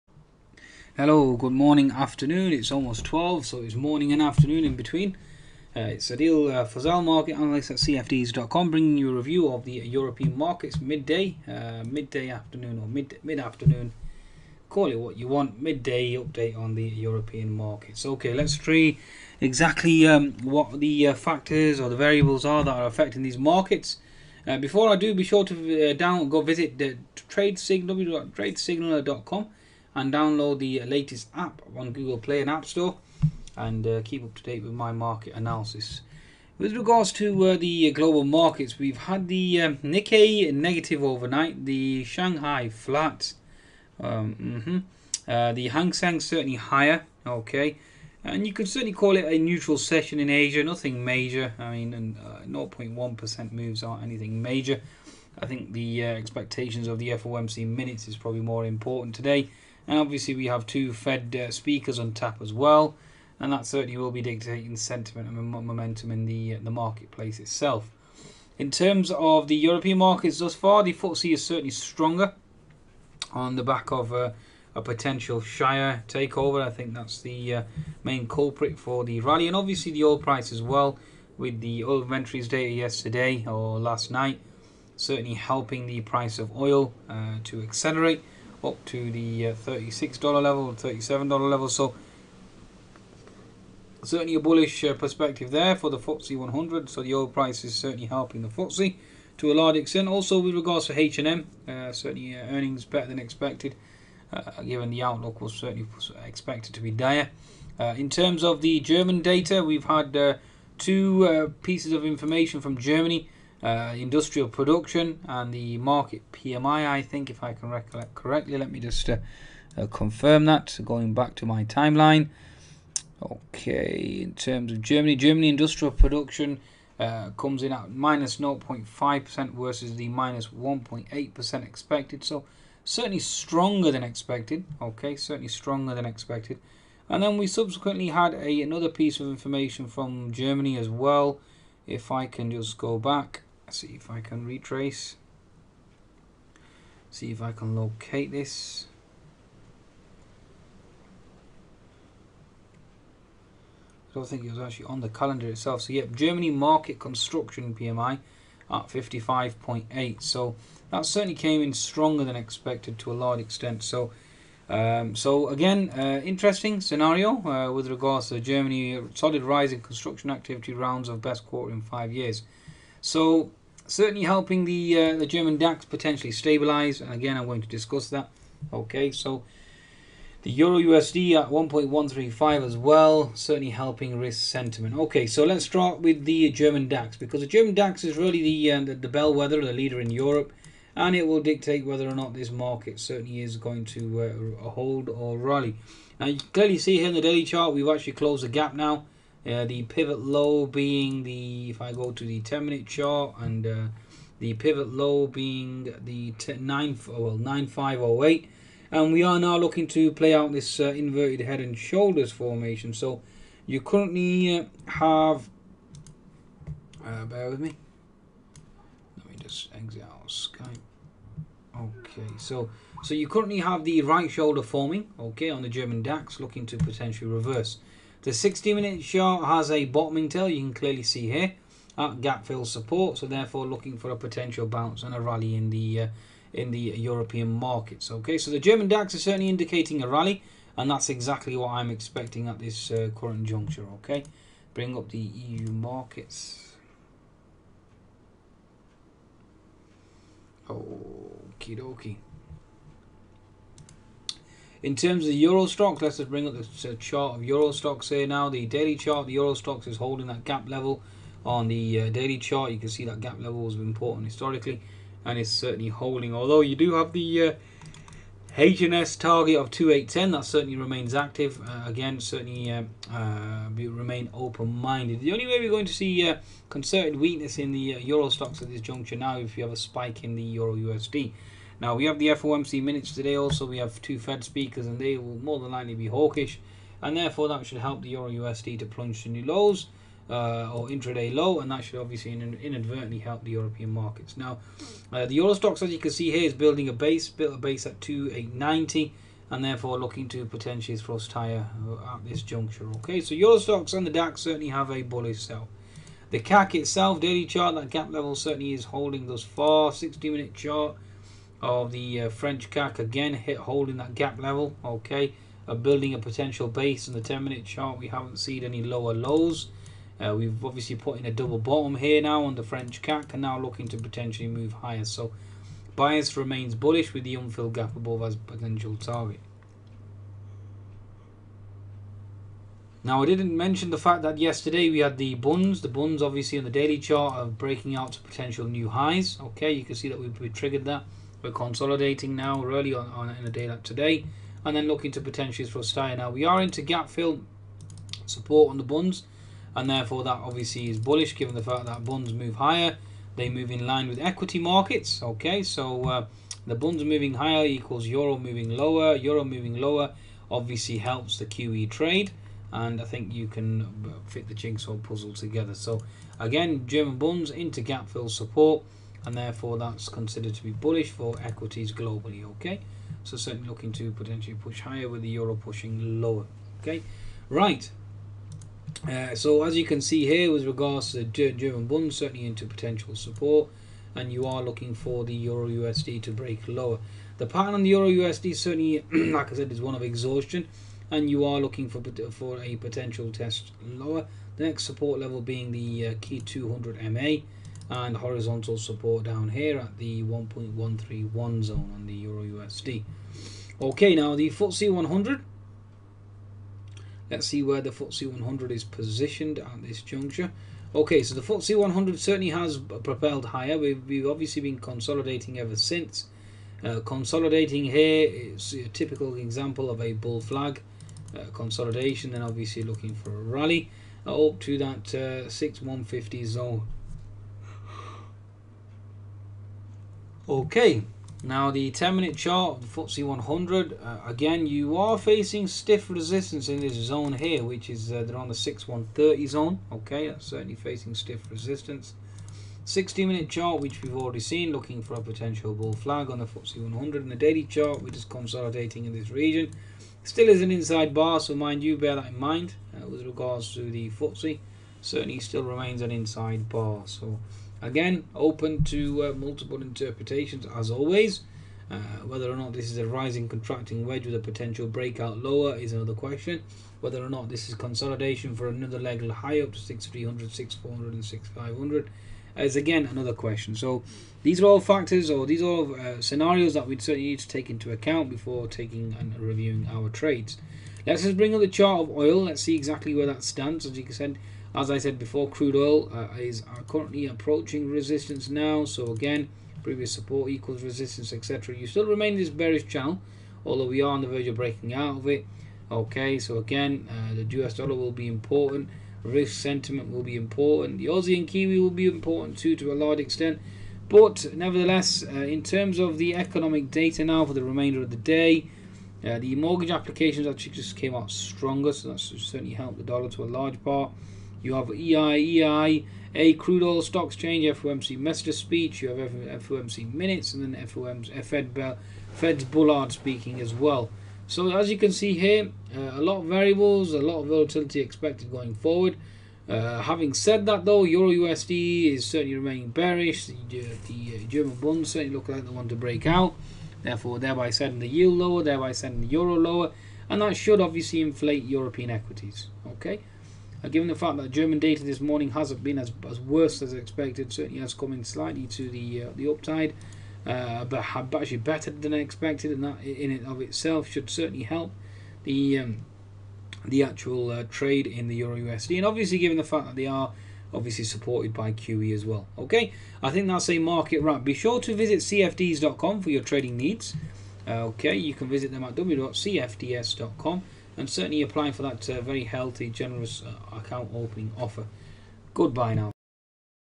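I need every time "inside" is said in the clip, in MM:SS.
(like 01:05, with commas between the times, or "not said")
07:30, 07:36.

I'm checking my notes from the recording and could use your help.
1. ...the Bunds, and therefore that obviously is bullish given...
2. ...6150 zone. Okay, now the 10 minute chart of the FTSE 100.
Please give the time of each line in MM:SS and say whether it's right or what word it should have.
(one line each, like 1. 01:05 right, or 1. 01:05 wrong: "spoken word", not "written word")
1. 05:48 right
2. 07:05 right.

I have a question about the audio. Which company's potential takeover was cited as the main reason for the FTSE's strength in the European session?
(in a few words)
Shire.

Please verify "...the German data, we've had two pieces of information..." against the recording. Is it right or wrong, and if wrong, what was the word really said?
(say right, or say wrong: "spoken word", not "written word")
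right.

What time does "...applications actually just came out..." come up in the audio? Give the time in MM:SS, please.
08:29.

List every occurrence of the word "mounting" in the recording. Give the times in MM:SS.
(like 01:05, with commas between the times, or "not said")
not said.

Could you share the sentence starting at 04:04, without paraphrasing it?
Okay, bring up the EU markets.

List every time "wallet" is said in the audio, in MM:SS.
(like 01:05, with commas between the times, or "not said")
not said.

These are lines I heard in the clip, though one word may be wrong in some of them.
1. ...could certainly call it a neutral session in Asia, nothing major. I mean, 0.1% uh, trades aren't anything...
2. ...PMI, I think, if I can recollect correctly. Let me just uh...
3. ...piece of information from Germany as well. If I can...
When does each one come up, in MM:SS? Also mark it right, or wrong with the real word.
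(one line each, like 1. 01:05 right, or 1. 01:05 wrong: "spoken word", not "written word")
1. 00:48 wrong: "moves", not "trades"
2. 01:56 right
3. 02:18 right.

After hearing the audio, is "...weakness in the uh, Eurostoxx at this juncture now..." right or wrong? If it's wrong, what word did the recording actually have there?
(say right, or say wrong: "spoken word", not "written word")
right.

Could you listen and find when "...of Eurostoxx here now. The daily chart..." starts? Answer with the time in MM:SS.
04:17.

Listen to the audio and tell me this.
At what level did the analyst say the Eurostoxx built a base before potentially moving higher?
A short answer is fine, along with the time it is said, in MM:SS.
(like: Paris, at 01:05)
2890, at 04:57.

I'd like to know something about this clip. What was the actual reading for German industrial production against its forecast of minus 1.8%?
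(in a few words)
-0.5%.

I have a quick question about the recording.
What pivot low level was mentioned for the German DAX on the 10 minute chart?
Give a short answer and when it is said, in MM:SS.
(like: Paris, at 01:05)
9508, at 03:27.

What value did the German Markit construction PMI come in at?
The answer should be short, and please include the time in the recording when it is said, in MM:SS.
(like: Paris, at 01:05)
55.8, at 02:38.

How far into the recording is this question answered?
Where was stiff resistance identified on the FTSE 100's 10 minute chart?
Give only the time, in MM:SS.
07:18.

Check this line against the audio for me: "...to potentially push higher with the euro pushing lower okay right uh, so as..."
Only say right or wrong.
right.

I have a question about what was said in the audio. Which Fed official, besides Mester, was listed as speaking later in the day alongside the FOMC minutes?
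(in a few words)
Bullard.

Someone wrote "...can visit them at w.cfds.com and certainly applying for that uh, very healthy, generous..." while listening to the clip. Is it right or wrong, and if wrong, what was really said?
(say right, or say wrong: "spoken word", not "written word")
right.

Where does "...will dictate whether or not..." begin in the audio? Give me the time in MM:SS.
03:11.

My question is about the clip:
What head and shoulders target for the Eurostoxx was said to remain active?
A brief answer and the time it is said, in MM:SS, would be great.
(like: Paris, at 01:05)
2810, at 04:29.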